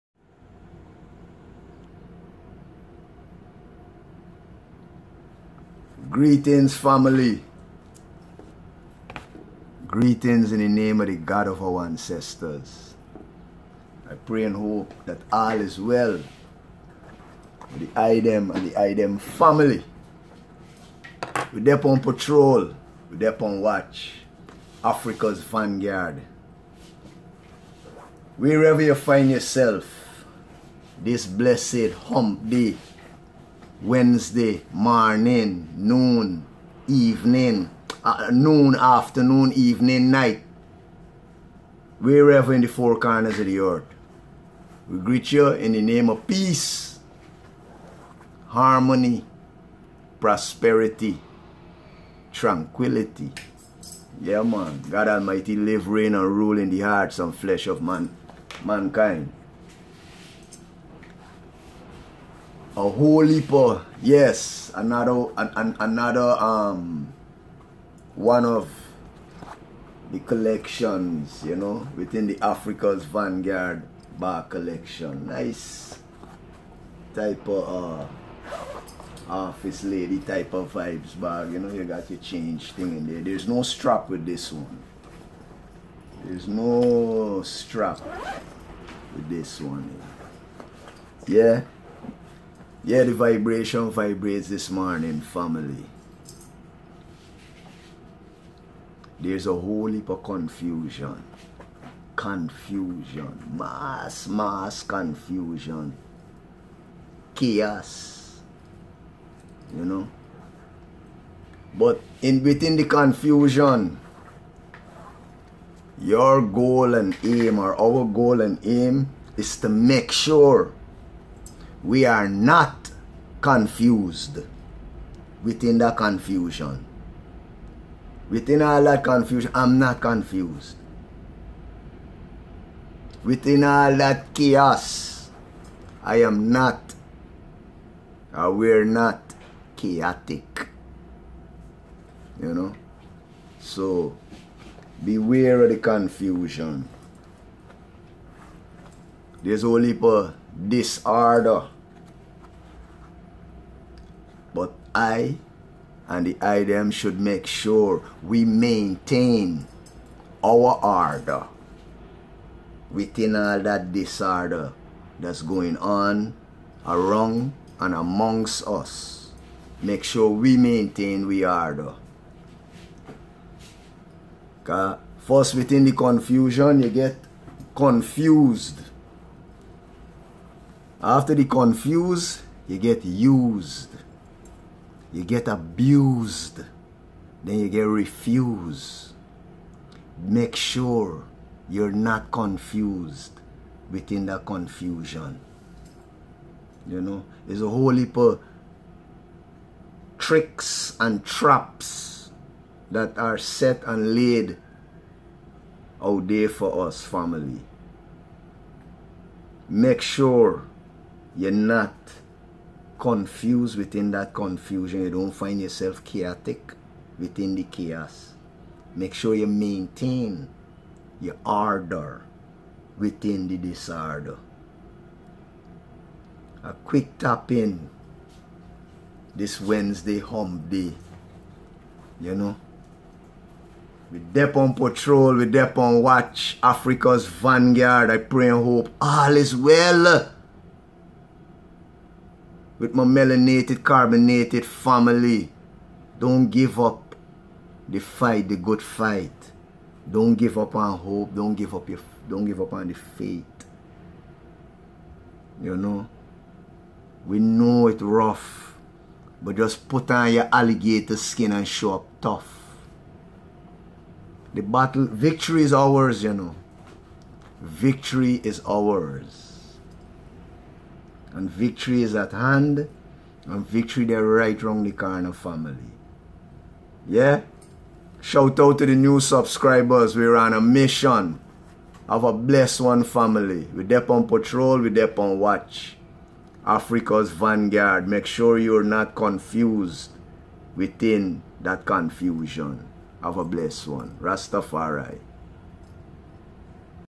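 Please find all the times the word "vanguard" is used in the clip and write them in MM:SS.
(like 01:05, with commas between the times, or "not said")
00:25, 01:13, 03:57, 04:47.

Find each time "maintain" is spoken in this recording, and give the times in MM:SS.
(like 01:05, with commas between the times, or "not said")
02:38, 02:50, 03:39.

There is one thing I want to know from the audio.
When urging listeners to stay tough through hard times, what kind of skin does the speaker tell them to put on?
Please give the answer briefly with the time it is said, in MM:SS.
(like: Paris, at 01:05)
Alligator skin, at 04:20.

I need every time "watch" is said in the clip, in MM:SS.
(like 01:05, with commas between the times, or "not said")
00:23, 03:56, 04:45.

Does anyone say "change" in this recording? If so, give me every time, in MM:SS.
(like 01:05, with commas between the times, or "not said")
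01:22.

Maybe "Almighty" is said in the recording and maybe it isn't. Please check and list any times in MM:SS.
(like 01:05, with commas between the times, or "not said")
00:55.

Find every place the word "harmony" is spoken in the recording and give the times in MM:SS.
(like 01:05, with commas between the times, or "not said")
00:48.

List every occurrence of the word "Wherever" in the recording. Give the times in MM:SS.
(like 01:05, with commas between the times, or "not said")
00:28, 00:41.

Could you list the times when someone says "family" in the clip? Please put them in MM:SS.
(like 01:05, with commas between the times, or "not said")
00:06, 00:19, 01:35, 03:27, 04:04, 04:35, 04:43.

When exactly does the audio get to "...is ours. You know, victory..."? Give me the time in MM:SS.
04:25.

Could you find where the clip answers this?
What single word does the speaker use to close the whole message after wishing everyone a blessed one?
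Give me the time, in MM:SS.
04:54.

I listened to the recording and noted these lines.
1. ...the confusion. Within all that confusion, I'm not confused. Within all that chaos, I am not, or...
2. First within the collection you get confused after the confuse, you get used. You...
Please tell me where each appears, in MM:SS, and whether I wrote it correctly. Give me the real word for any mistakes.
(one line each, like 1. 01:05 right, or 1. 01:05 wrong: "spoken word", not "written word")
1. 02:05 right
2. 02:55 wrong: "confusion", not "collection".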